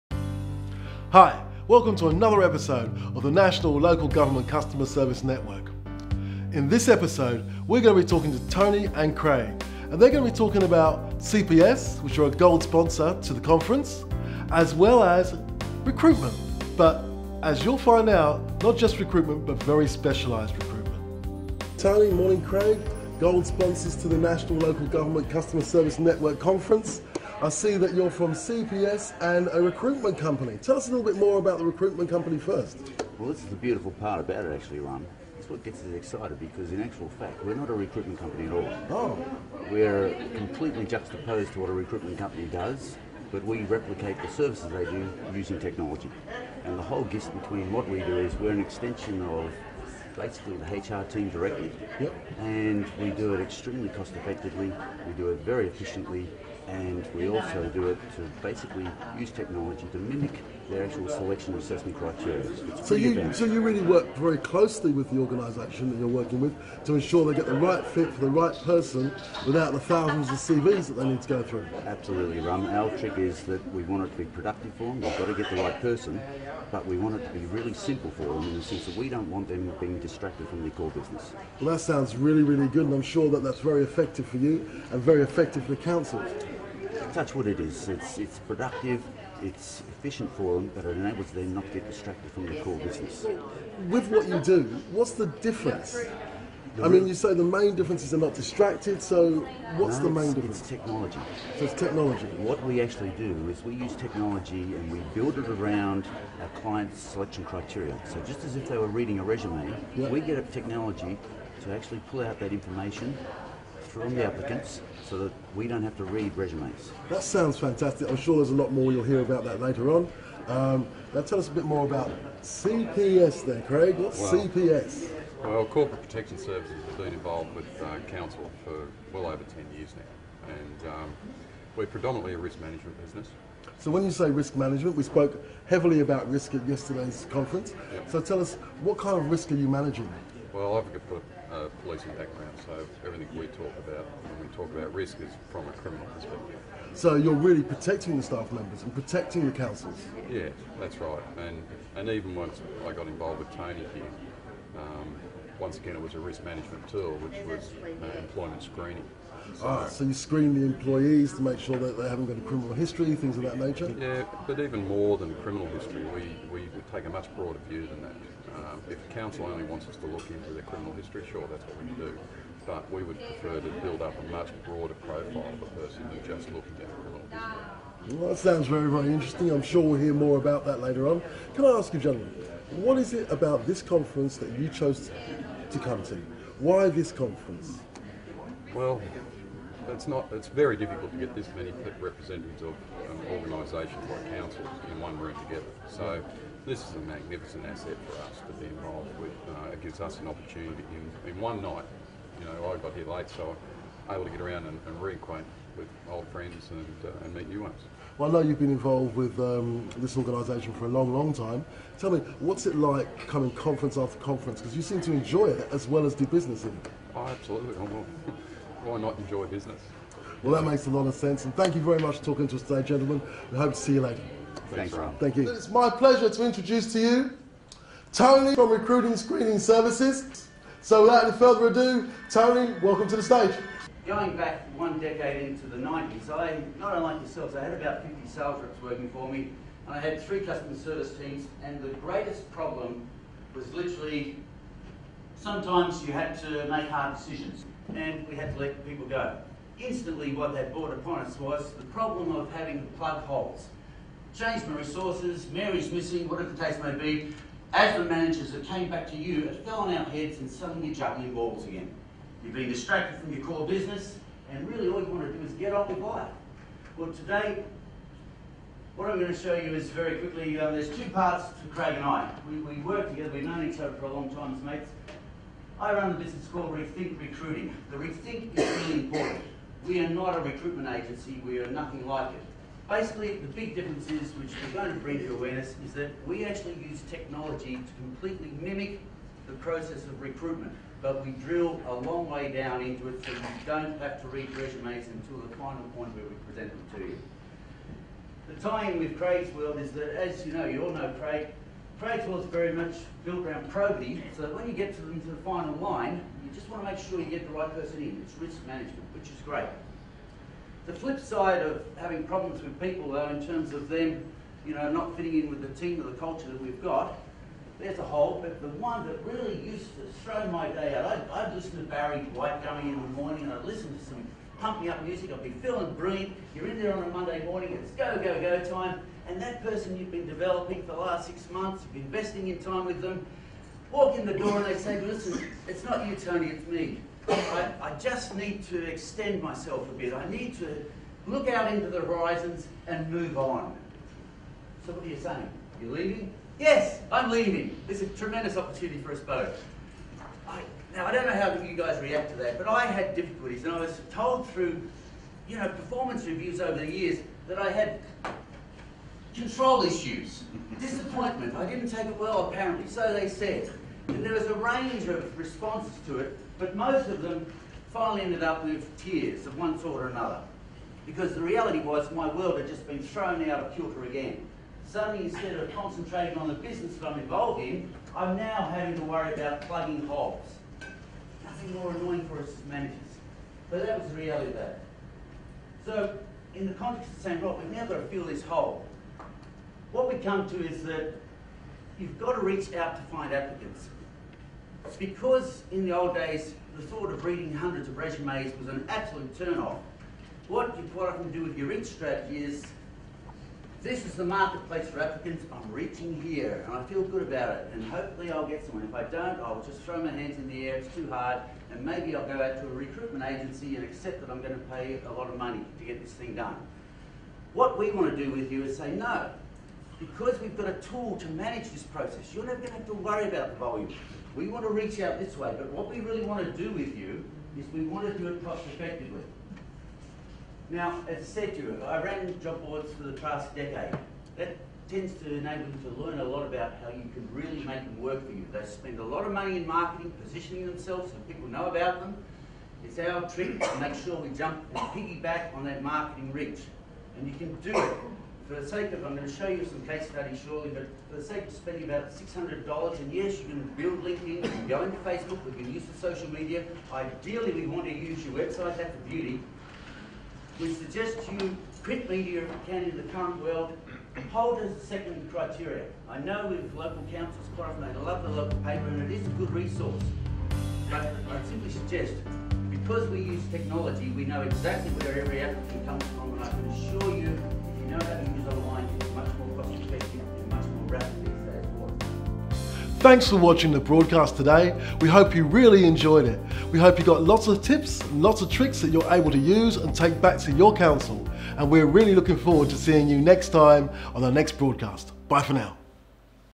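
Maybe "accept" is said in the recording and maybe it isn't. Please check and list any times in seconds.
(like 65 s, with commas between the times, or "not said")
413 s.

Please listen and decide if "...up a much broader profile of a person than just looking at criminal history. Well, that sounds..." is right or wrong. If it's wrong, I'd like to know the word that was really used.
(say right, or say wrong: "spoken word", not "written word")
right.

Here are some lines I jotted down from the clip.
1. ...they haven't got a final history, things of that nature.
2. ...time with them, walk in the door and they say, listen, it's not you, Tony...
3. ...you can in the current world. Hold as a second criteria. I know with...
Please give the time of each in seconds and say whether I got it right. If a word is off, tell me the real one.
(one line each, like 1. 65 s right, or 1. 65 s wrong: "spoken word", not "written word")
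1. 161 s wrong: "criminal", not "final"
2. 332 s right
3. 462 s right.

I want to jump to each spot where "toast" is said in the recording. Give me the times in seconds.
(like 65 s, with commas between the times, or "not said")
not said.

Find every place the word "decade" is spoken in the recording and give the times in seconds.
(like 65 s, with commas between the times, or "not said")
234 s, 433 s.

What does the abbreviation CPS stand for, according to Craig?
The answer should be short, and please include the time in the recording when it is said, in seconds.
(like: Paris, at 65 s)
Corporate Protection Services, at 125 s.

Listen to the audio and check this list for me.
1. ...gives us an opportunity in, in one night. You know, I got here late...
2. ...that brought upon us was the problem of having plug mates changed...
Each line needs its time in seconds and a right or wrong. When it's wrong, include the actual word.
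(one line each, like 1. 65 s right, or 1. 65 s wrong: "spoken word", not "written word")
1. 199 s right
2. 250 s wrong: "holes", not "mates".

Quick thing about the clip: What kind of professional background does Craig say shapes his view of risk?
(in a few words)
Policing.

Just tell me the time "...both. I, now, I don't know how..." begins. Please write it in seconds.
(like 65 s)
349 s.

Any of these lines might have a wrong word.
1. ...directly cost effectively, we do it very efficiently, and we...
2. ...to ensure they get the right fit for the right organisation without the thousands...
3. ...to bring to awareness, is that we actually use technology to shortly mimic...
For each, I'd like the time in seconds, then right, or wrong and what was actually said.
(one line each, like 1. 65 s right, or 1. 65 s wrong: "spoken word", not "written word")
1. 53 s wrong: "extremely", not "directly"
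2. 66 s wrong: "person", not "organisation"
3. 284 s wrong: "completely", not "shortly".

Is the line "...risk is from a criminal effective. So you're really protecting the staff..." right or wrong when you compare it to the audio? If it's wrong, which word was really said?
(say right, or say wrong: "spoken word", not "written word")
wrong: "perspective", not "effective".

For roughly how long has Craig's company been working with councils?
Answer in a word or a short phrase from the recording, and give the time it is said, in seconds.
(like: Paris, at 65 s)
Over 10 years, at 129 s.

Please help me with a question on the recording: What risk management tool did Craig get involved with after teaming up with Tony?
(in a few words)
Employment screening.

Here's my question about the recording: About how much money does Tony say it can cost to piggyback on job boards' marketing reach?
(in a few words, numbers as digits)
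$600.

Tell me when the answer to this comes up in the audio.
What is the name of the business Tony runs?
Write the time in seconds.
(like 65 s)
276 s.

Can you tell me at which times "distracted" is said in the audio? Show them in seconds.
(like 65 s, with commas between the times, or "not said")
79 s, 91 s, 98 s, 262 s.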